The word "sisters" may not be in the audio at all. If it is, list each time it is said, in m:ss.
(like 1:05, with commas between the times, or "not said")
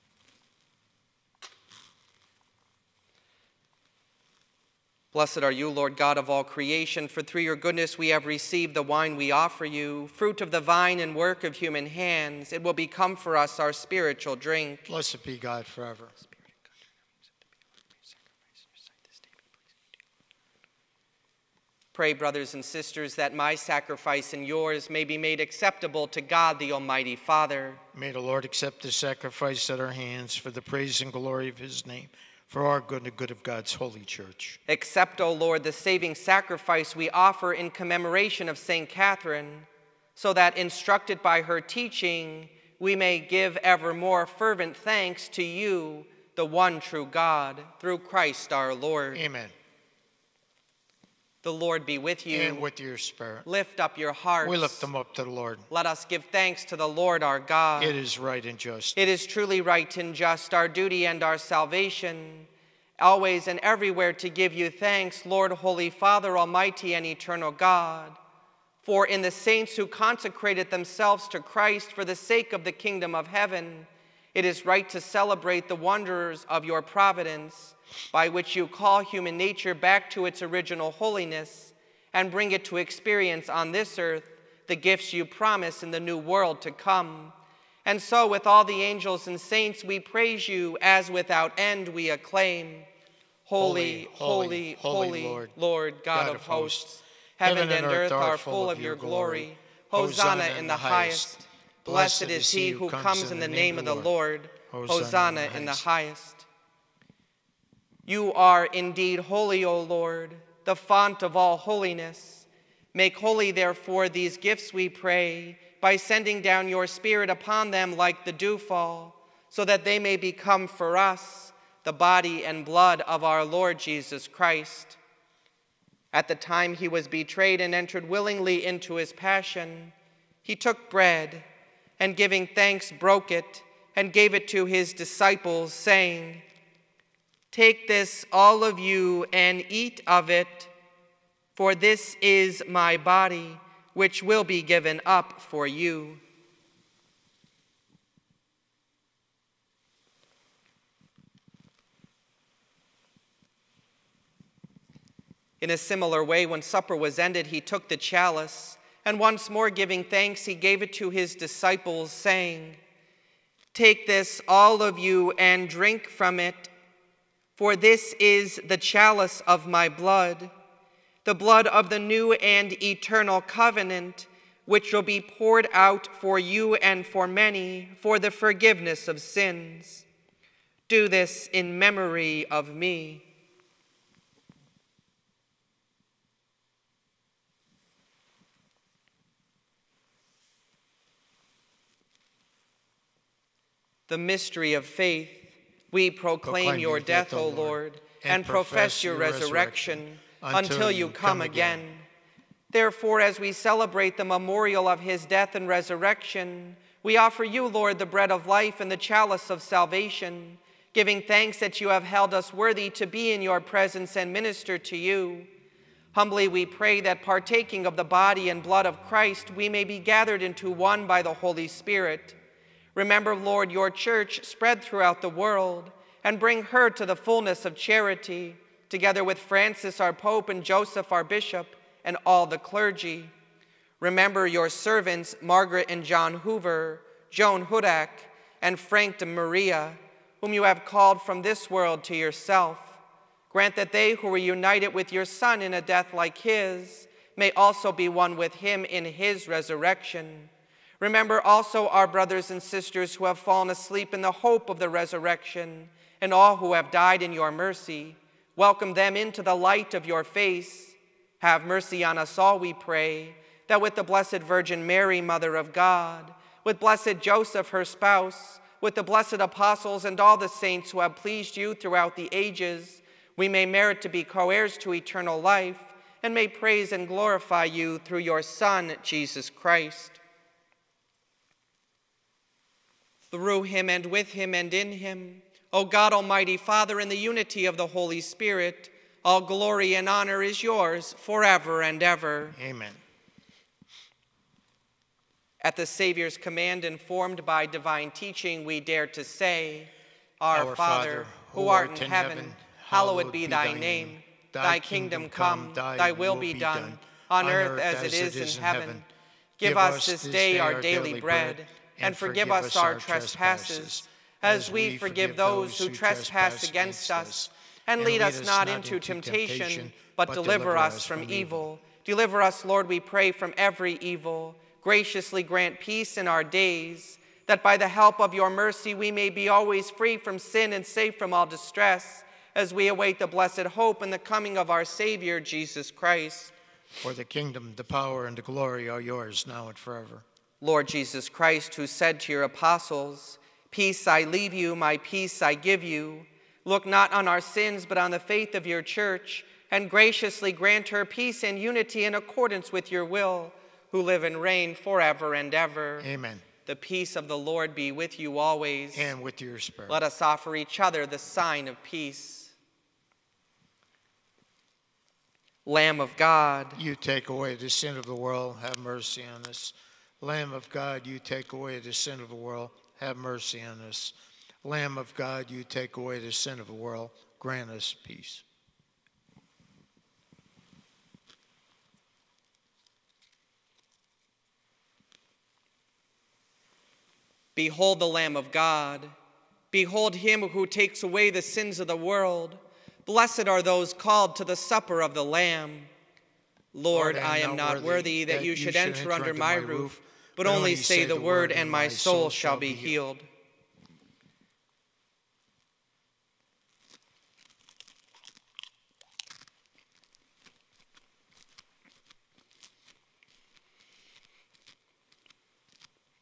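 0:22, 4:12.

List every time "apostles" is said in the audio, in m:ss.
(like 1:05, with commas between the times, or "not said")
4:29, 5:42.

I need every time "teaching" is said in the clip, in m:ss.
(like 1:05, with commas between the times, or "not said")
0:41, 4:58.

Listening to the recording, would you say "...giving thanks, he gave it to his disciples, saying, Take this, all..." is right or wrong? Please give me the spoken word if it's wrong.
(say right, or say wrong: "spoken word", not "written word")
right.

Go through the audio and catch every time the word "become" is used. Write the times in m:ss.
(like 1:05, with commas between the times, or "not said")
0:12, 2:00.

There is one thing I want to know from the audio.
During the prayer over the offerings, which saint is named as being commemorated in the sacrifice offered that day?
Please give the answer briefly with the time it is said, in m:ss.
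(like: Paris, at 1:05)
St. Catherine, at 0:38.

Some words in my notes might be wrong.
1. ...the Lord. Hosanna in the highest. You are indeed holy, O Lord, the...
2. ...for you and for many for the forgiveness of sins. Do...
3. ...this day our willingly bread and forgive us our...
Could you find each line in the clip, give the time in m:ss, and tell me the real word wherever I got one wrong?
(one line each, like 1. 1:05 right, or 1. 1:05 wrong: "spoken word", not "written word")
1. 1:43 right
2. 2:56 right
3. 5:10 wrong: "daily", not "willingly".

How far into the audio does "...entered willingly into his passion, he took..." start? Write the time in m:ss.
2:07.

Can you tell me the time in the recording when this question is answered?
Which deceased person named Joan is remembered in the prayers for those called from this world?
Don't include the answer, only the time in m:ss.
3:57.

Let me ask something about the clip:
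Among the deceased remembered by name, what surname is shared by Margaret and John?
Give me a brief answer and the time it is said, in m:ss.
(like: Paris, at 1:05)
Hoover, at 3:56.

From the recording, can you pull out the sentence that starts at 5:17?
And lead us not into temptation, but deliver us from evil.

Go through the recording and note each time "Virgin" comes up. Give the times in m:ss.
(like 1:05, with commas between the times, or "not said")
4:24.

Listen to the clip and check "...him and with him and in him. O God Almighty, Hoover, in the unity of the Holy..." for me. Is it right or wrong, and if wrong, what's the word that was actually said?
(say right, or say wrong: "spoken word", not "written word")
wrong: "Father", not "Hoover".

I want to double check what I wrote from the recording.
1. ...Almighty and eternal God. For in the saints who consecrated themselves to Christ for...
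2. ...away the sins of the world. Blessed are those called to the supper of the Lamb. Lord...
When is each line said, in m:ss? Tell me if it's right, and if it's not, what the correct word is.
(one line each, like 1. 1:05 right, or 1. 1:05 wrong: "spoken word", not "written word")
1. 1:06 right
2. 6:31 right.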